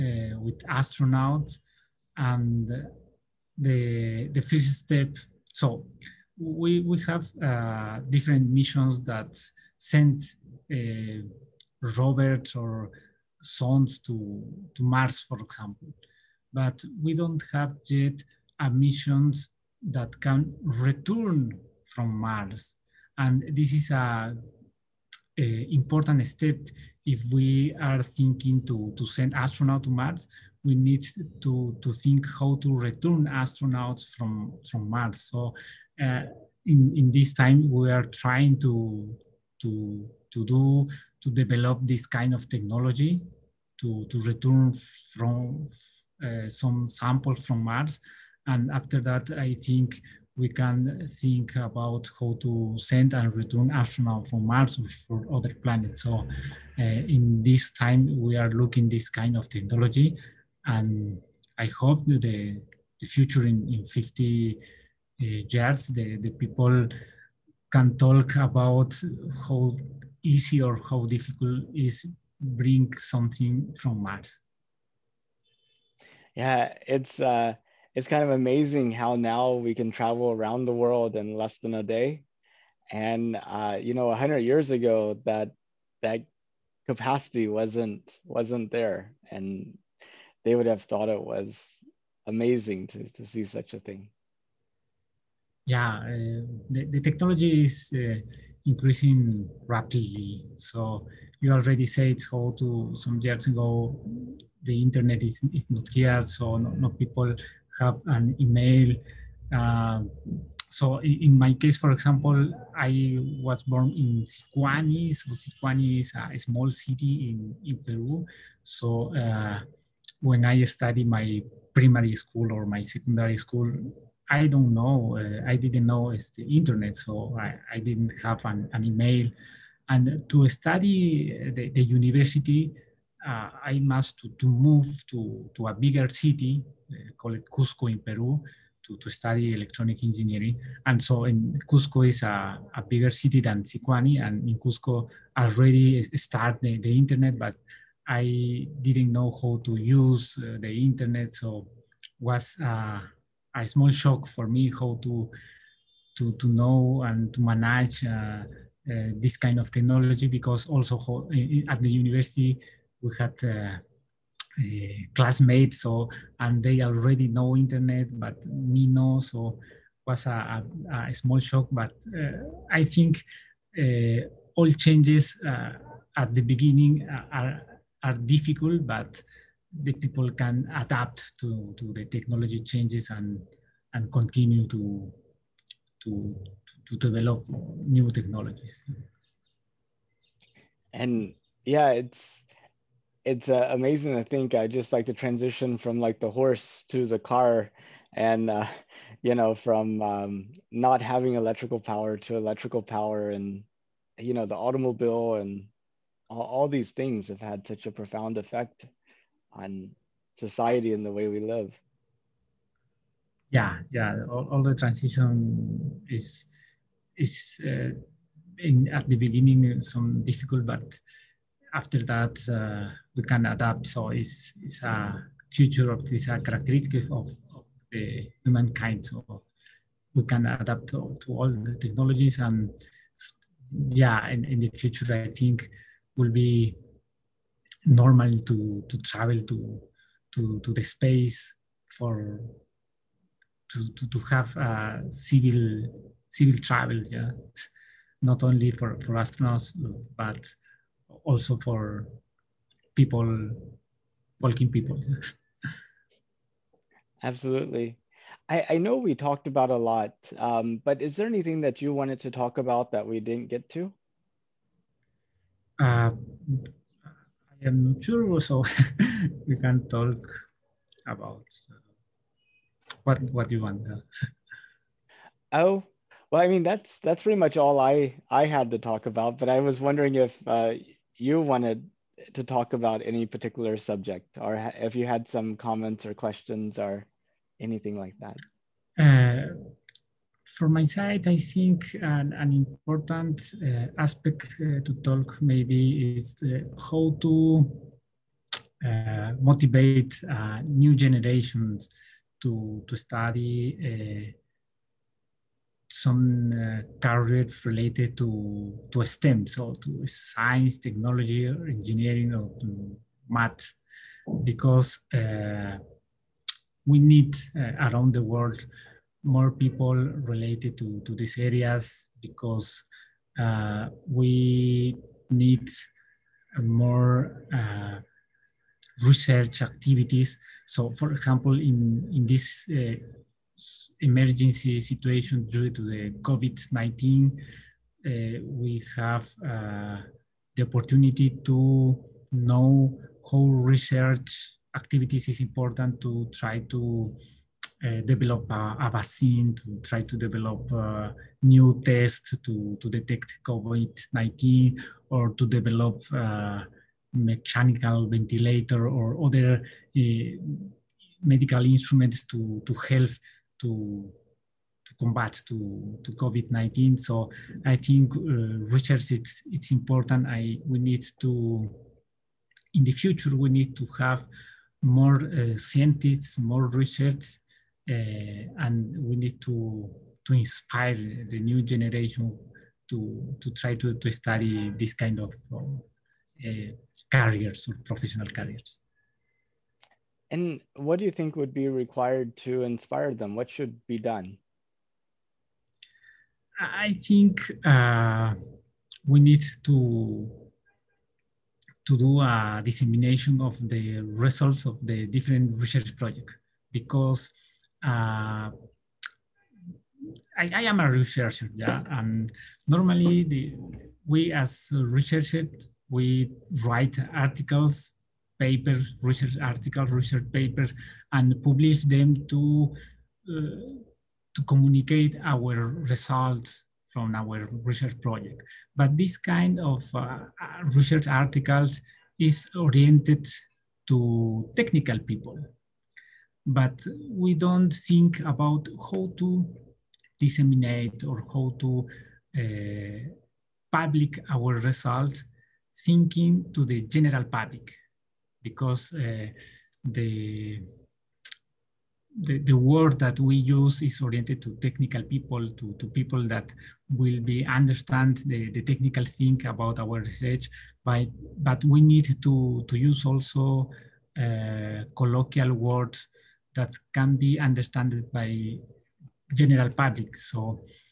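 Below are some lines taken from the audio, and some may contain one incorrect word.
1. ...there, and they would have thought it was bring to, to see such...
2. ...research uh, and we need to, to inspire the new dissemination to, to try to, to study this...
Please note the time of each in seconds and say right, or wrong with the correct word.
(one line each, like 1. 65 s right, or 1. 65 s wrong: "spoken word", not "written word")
1. 88 s wrong: "amazing", not "bring"
2. 376 s wrong: "generation", not "dissemination".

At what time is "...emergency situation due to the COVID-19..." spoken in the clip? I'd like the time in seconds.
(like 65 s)
333 s.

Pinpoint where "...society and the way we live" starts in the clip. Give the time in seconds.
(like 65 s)
210 s.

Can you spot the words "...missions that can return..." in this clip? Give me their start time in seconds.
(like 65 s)
18 s.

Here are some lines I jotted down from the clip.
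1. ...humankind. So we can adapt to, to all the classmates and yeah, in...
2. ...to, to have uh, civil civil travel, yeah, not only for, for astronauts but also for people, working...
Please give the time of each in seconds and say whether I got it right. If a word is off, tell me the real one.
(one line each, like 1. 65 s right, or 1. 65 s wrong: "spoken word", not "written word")
1. 228 s wrong: "technologies", not "classmates"
2. 243 s right.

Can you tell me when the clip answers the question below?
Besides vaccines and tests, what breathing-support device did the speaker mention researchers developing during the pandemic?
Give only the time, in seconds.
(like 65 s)
357 s.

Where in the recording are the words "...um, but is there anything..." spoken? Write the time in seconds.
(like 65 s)
260 s.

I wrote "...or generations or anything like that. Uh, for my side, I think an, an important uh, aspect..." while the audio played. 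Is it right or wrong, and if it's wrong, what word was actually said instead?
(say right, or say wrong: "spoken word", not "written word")
wrong: "questions", not "generations".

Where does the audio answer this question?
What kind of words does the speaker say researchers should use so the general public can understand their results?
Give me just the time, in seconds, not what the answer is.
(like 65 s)
464 s.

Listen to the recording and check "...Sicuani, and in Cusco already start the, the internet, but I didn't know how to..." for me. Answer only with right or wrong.
right.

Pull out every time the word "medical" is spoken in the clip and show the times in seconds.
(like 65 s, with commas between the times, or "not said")
361 s.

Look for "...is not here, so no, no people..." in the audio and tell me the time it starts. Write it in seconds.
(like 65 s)
105 s.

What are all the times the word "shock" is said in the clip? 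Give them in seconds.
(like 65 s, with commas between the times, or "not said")
153 s, 171 s.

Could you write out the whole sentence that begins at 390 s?
And what do you think would be required to inspire them?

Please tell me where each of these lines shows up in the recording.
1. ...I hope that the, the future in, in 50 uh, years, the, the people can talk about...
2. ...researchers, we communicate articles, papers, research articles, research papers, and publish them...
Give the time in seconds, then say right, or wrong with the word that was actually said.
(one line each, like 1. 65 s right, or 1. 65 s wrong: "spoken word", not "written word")
1. 61 s right
2. 414 s wrong: "write", not "communicate".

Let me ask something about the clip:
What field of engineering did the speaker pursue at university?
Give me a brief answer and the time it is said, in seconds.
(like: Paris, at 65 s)
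Electronic engineering, at 139 s.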